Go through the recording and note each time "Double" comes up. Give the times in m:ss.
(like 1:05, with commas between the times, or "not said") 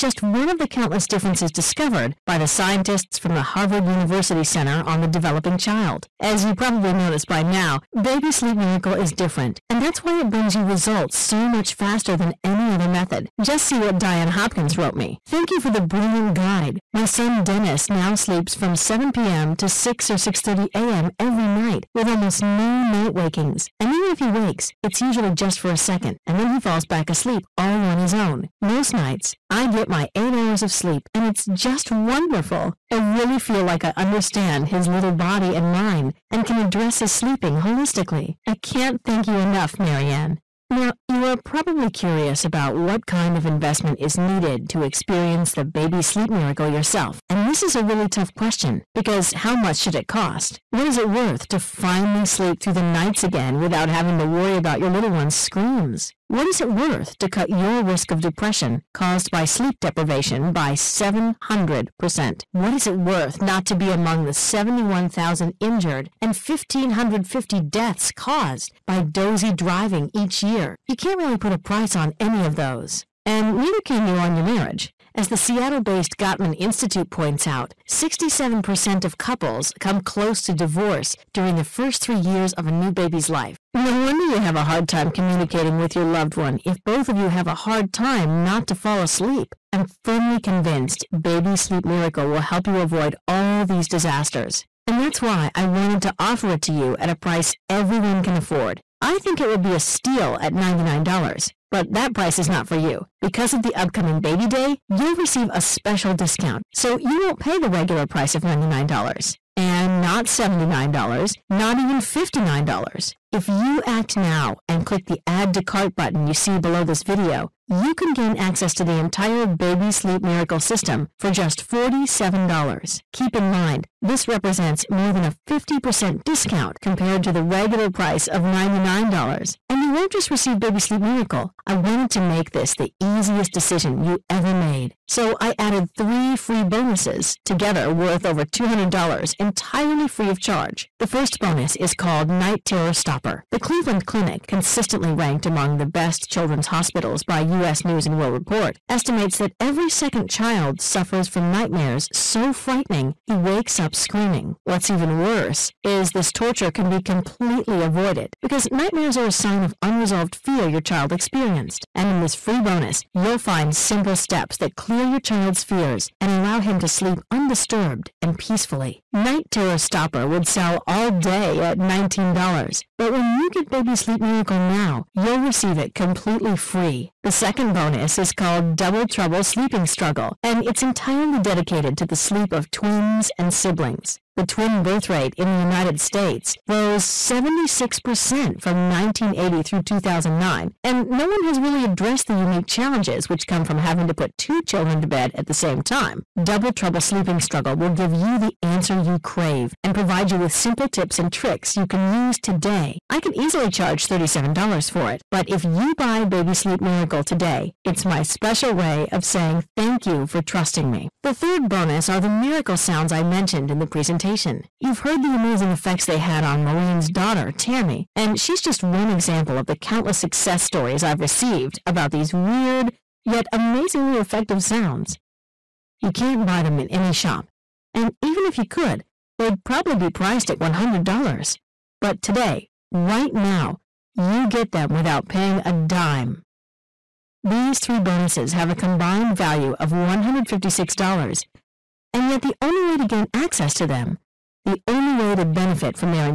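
2:58, 3:16.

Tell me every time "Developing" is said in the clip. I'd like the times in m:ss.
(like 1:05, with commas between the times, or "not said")
0:05.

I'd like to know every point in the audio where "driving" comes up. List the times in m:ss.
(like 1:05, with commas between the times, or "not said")
1:09.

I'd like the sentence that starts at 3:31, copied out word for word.
The third bonus are the miracle sounds I mentioned in the presentation presentation.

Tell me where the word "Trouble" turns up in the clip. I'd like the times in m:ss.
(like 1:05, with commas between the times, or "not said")
2:59, 3:16.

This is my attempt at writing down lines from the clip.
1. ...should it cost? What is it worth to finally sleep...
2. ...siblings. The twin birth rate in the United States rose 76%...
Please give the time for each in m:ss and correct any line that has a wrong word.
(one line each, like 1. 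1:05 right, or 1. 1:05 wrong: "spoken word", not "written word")
1. 0:49 right
2. 3:03 right.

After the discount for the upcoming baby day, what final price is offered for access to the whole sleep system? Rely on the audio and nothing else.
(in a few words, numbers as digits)
$47.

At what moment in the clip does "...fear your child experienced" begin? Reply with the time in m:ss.
2:40.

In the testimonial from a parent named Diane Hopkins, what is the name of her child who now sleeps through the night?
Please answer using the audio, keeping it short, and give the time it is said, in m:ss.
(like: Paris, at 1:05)
Dennis, at 0:17.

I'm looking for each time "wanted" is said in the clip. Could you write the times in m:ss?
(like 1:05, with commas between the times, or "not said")
1:35, 2:11.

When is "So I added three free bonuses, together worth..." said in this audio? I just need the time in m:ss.
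2:15.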